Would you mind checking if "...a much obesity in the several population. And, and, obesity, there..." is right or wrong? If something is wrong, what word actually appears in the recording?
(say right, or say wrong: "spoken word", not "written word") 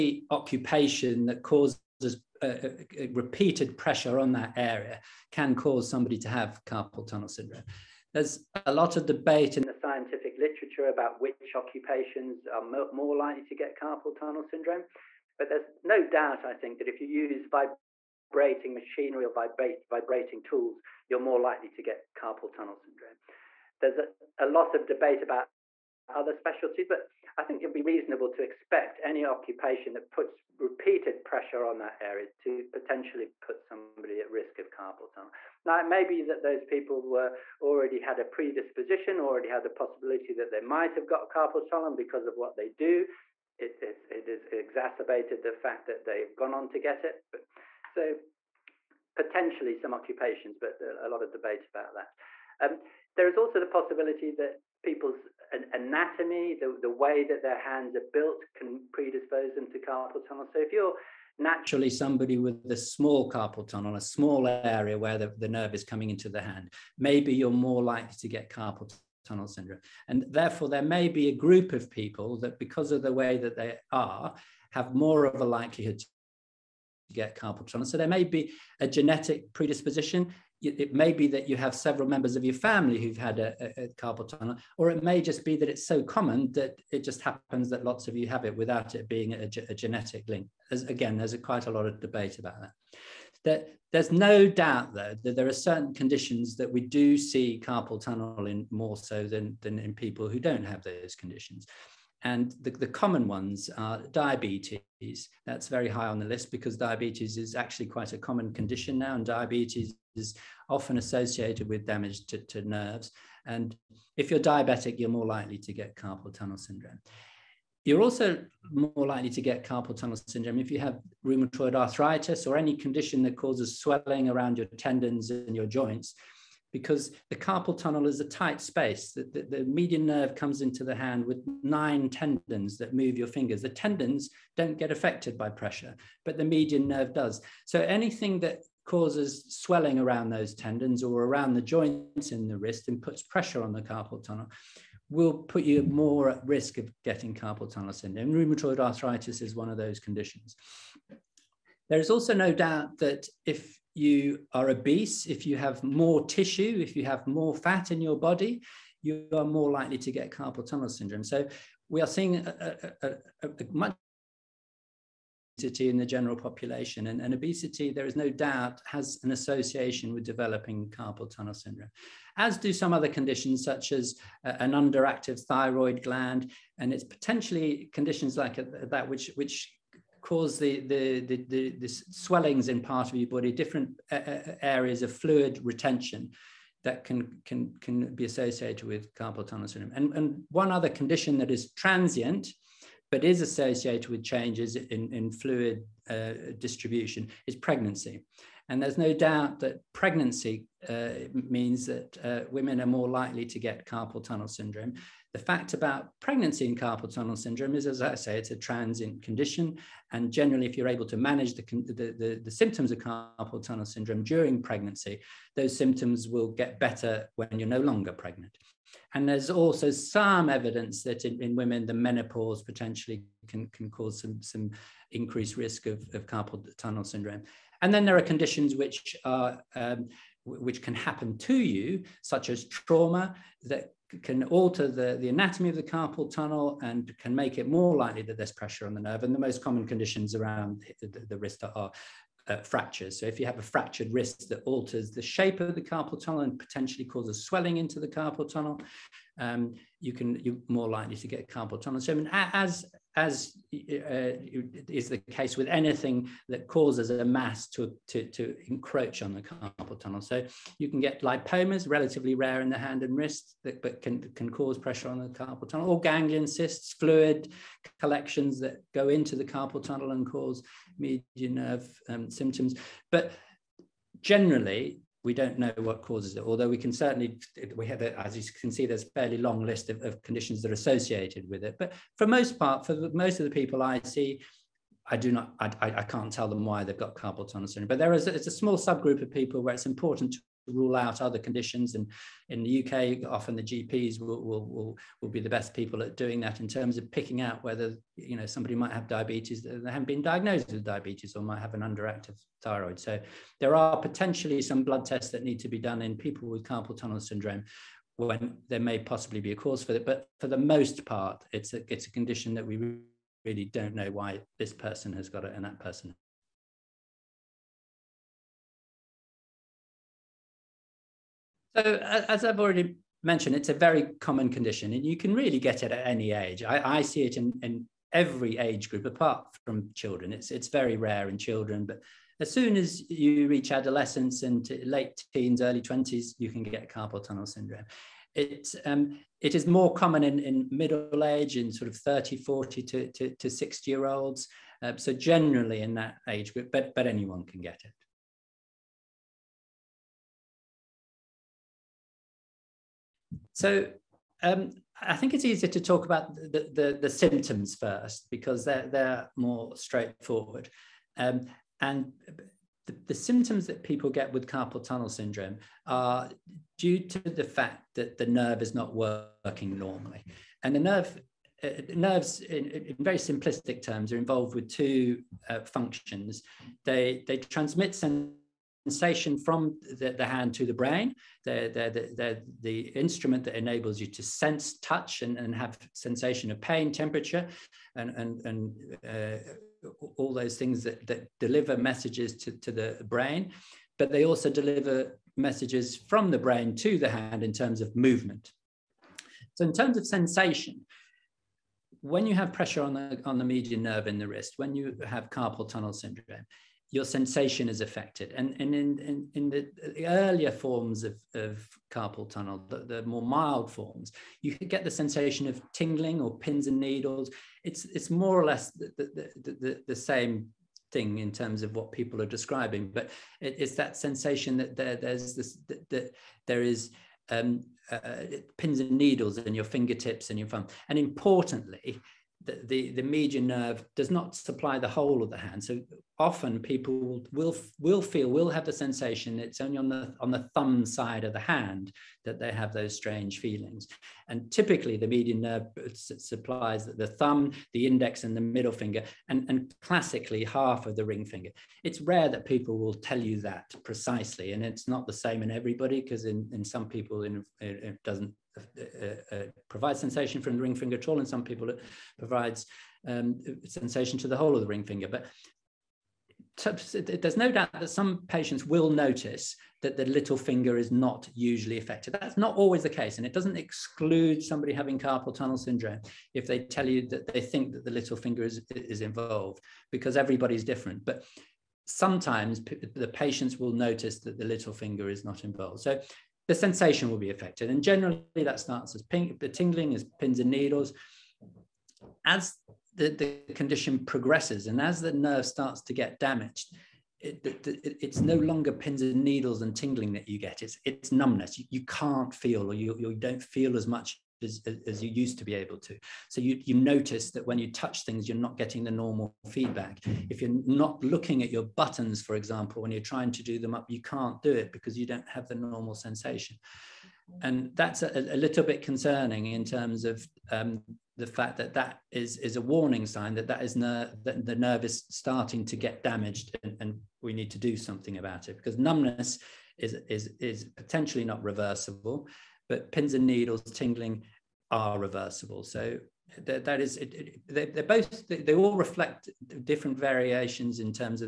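wrong: "general", not "several".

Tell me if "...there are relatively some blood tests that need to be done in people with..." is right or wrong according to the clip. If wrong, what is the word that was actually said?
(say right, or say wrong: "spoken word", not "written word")
wrong: "potentially", not "relatively".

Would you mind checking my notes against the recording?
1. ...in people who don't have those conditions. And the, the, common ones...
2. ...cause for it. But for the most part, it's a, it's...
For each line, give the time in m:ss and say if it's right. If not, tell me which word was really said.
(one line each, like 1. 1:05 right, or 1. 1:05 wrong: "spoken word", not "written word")
1. 1:39 right
2. 5:09 right.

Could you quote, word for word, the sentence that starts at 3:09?
And, and one other condition that is transient, but is associated with changes in, in fluid uh, distribution is pregnancy.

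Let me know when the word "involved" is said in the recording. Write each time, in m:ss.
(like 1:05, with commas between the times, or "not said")
6:14, 7:59, 8:05.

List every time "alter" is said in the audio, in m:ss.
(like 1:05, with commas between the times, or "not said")
3:54, 4:04.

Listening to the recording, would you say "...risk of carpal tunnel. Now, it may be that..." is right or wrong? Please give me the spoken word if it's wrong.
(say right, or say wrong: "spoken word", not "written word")
right.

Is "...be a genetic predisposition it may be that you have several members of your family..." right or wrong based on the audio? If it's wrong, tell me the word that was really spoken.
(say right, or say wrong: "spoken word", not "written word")
right.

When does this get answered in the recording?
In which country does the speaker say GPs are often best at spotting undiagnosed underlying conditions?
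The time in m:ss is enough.
4:52.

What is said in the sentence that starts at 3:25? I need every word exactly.
The fact about pregnancy and carpal tunnel syndrome is, as I say, it's a transient condition.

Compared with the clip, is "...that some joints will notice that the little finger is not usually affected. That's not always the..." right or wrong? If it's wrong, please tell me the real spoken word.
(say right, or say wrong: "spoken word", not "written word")
wrong: "patients", not "joints".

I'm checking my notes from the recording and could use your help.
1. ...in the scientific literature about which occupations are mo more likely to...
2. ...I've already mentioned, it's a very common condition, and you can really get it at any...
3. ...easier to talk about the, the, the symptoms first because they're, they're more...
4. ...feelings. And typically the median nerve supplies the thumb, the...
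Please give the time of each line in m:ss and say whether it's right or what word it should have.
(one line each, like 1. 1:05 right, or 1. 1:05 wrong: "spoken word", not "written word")
1. 0:09 right
2. 5:22 right
3. 5:55 right
4. 7:23 right.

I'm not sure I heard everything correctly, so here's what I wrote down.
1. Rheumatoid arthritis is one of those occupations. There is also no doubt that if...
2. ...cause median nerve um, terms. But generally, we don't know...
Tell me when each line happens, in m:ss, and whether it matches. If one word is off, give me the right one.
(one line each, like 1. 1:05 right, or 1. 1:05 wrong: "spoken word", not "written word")
1. 2:28 wrong: "conditions", not "occupations"
2. 4:30 wrong: "symptoms", not "terms".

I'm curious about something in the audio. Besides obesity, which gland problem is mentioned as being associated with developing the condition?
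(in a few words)
Underactive thyroid gland.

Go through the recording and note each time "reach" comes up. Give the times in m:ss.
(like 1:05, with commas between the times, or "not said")
5:33.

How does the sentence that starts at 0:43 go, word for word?
It, it's, it is exacerbated the fact that they've gone on to get it.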